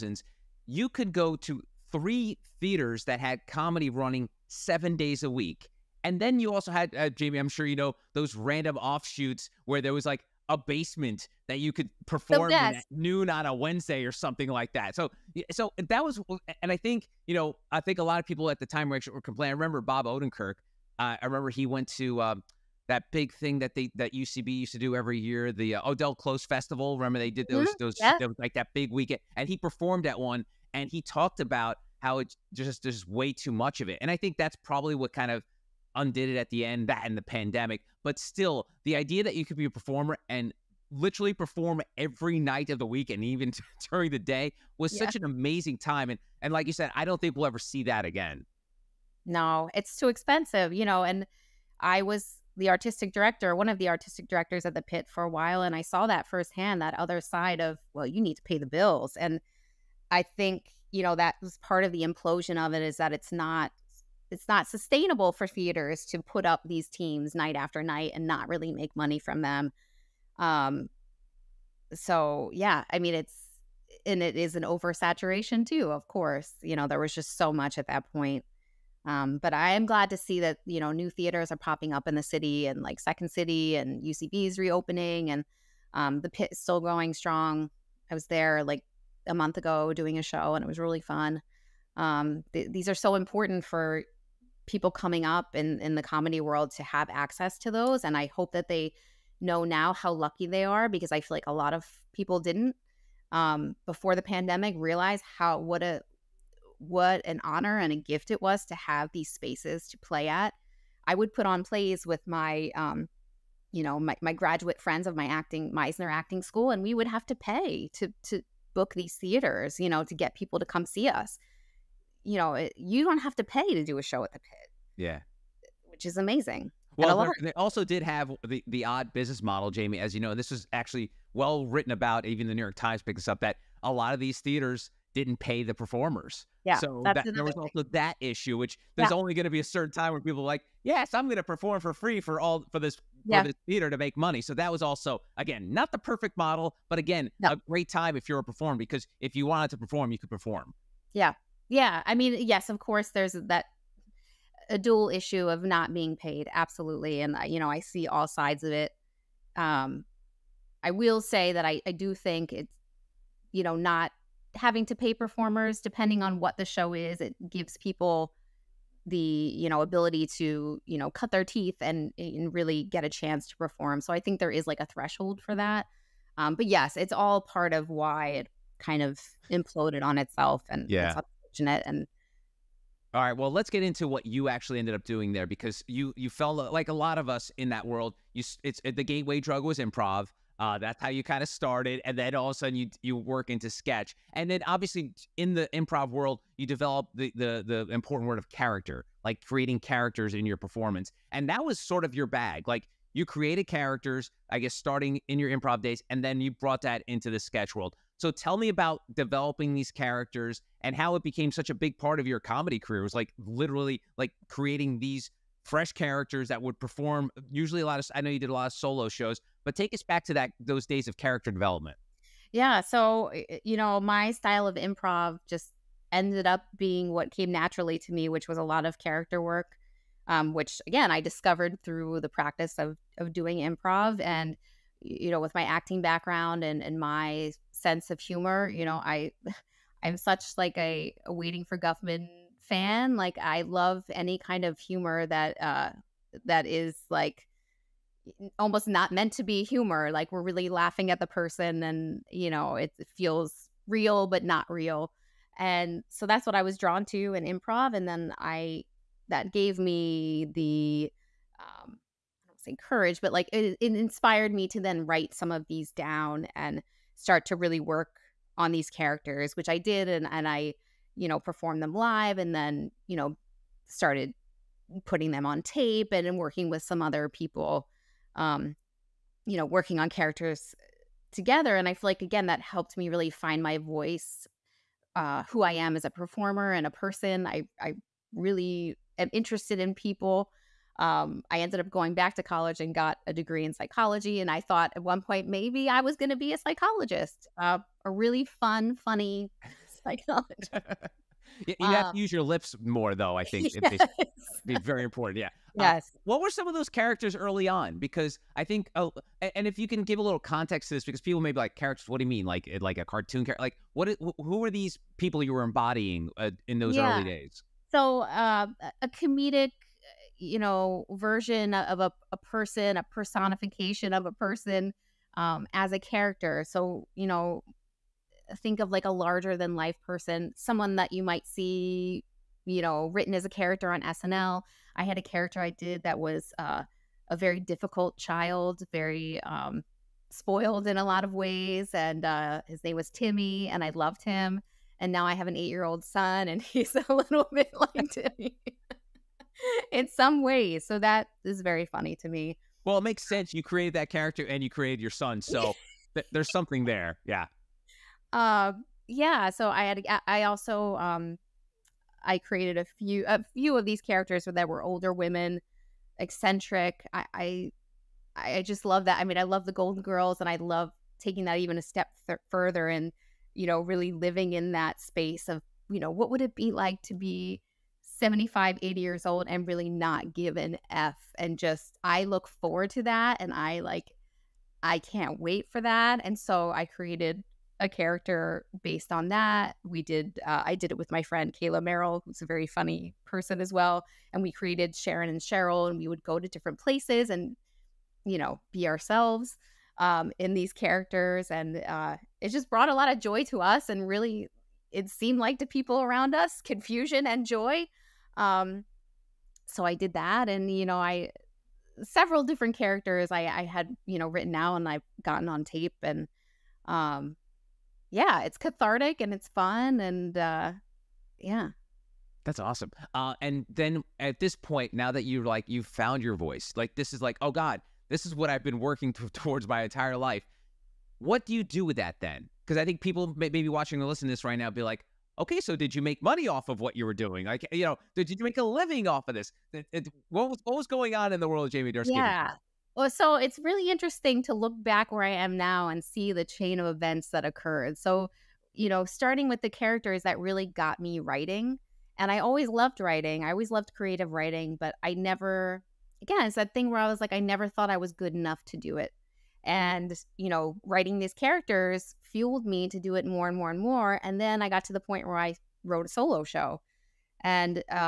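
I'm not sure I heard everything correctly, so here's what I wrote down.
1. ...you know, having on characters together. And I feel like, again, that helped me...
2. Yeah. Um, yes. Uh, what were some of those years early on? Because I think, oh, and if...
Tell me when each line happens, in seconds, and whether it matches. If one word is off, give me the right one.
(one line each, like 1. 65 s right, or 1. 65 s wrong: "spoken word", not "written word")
1. 279 s wrong: "working", not "having"
2. 305 s wrong: "characters", not "years".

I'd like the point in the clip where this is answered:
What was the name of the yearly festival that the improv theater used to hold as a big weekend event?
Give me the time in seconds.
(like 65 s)
25 s.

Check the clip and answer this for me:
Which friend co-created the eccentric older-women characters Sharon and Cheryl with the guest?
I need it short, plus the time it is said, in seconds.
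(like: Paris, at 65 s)
Kayla Merrill, at 391 s.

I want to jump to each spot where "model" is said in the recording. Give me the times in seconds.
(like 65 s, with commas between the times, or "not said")
129 s, 146 s.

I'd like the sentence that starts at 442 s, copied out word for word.
Yeah, so it's really interesting to look back where I am now and see the chain of events that occurred.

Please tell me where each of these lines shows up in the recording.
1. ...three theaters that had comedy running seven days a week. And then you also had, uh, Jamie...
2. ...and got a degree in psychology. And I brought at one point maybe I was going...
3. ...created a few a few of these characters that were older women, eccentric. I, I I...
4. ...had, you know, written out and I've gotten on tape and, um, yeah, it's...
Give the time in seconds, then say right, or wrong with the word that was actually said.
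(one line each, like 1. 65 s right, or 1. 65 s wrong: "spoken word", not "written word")
1. 1 s right
2. 292 s wrong: "thought", not "brought"
3. 362 s right
4. 413 s right.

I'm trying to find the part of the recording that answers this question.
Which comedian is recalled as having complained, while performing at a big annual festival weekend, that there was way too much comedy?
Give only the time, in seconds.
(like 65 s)
19 s.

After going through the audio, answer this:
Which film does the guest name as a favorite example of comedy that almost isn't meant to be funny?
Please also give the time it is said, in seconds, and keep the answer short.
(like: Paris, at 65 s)
Waiting for Guffman, at 241 s.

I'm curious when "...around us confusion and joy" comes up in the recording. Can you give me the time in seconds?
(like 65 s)
406 s.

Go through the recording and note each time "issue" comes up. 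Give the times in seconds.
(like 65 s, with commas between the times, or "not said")
138 s, 155 s.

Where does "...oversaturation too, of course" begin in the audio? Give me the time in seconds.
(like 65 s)
74 s.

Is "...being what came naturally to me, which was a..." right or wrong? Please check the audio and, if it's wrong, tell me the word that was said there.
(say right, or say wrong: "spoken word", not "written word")
right.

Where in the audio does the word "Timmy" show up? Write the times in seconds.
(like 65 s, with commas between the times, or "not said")
343 s, 348 s.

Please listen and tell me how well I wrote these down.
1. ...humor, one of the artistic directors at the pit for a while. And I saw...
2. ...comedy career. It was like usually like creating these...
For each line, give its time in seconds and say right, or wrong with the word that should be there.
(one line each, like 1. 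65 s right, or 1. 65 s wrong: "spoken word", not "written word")
1. 53 s wrong: "director", not "humor"
2. 212 s wrong: "literally", not "usually".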